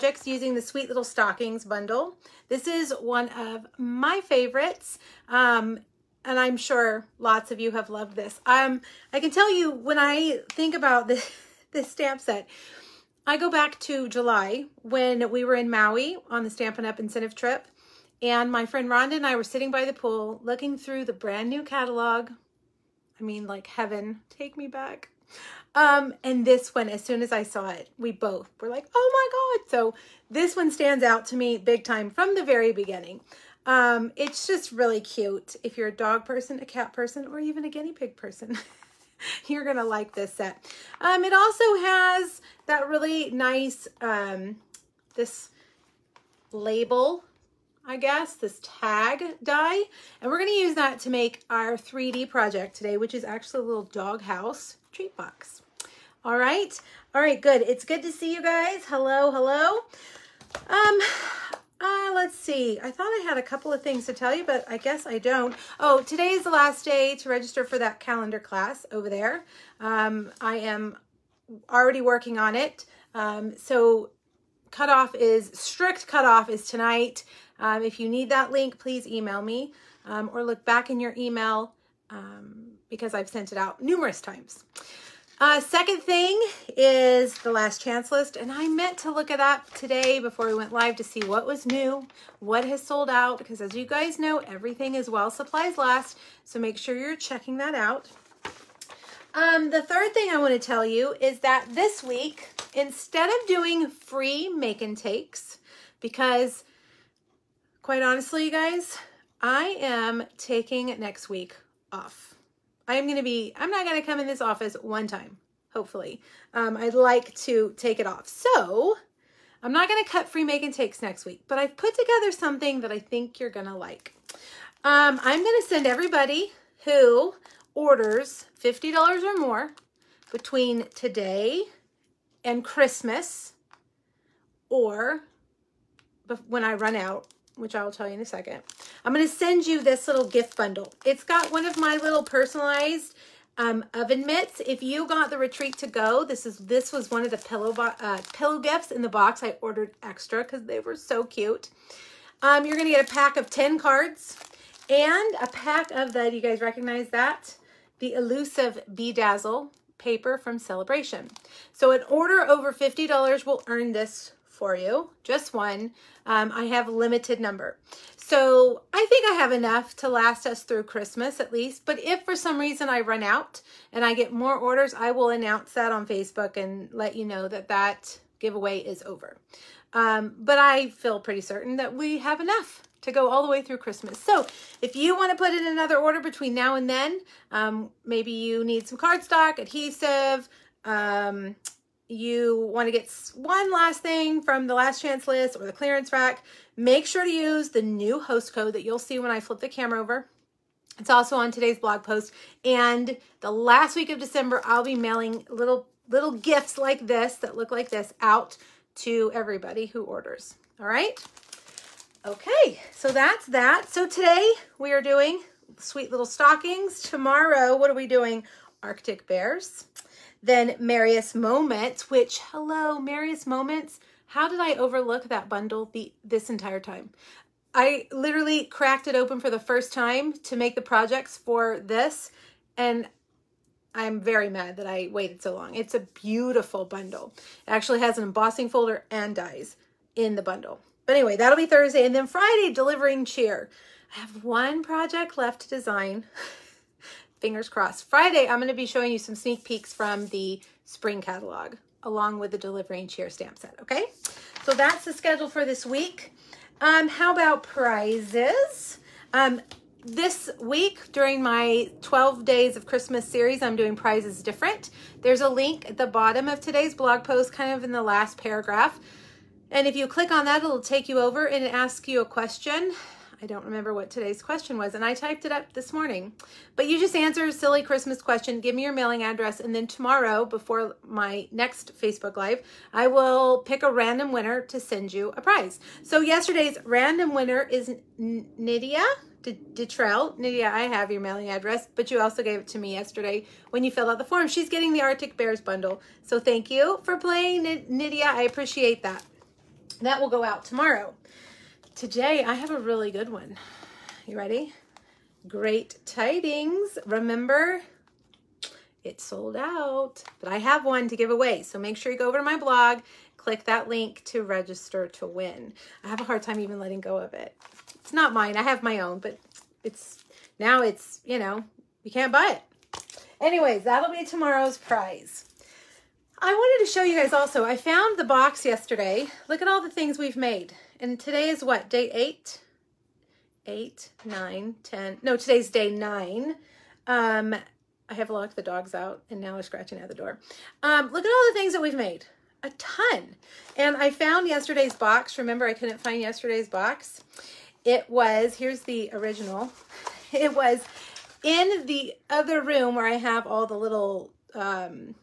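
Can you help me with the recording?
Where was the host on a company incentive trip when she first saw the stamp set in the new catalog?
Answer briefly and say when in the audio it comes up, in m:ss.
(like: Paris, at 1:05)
Maui, at 0:15.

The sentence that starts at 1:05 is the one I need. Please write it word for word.
Oh, today is the last day to register for that calendar class over there.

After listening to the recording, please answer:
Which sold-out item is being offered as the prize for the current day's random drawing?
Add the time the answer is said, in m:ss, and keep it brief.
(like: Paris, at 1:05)
Great Tidings, at 5:05.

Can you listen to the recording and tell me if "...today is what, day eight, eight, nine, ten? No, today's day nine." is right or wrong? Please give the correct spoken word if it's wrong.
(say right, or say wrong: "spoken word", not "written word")
right.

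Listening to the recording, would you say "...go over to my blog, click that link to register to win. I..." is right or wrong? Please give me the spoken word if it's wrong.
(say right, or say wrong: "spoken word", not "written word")
right.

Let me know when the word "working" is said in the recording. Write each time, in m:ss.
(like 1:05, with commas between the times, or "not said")
1:12.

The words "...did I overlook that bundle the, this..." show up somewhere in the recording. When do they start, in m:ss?
3:44.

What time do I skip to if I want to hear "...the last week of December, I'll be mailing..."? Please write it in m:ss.
3:23.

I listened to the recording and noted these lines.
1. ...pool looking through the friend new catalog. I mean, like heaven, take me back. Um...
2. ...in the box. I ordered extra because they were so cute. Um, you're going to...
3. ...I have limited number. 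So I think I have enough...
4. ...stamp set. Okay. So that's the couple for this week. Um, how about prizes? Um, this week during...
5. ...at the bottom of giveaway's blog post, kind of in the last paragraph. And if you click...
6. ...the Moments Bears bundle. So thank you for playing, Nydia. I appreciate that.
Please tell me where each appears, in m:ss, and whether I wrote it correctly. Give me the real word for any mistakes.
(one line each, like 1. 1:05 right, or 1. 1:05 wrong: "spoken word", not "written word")
1. 0:19 wrong: "brand", not "friend"
2. 2:28 right
3. 2:46 right
4. 4:13 wrong: "schedule", not "couple"
5. 4:25 wrong: "today", not "giveaway"
6. 4:54 wrong: "Arctic", not "Moments".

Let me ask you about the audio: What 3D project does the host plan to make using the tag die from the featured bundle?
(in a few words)
dog house treat box.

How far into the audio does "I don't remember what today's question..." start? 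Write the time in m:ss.
4:33.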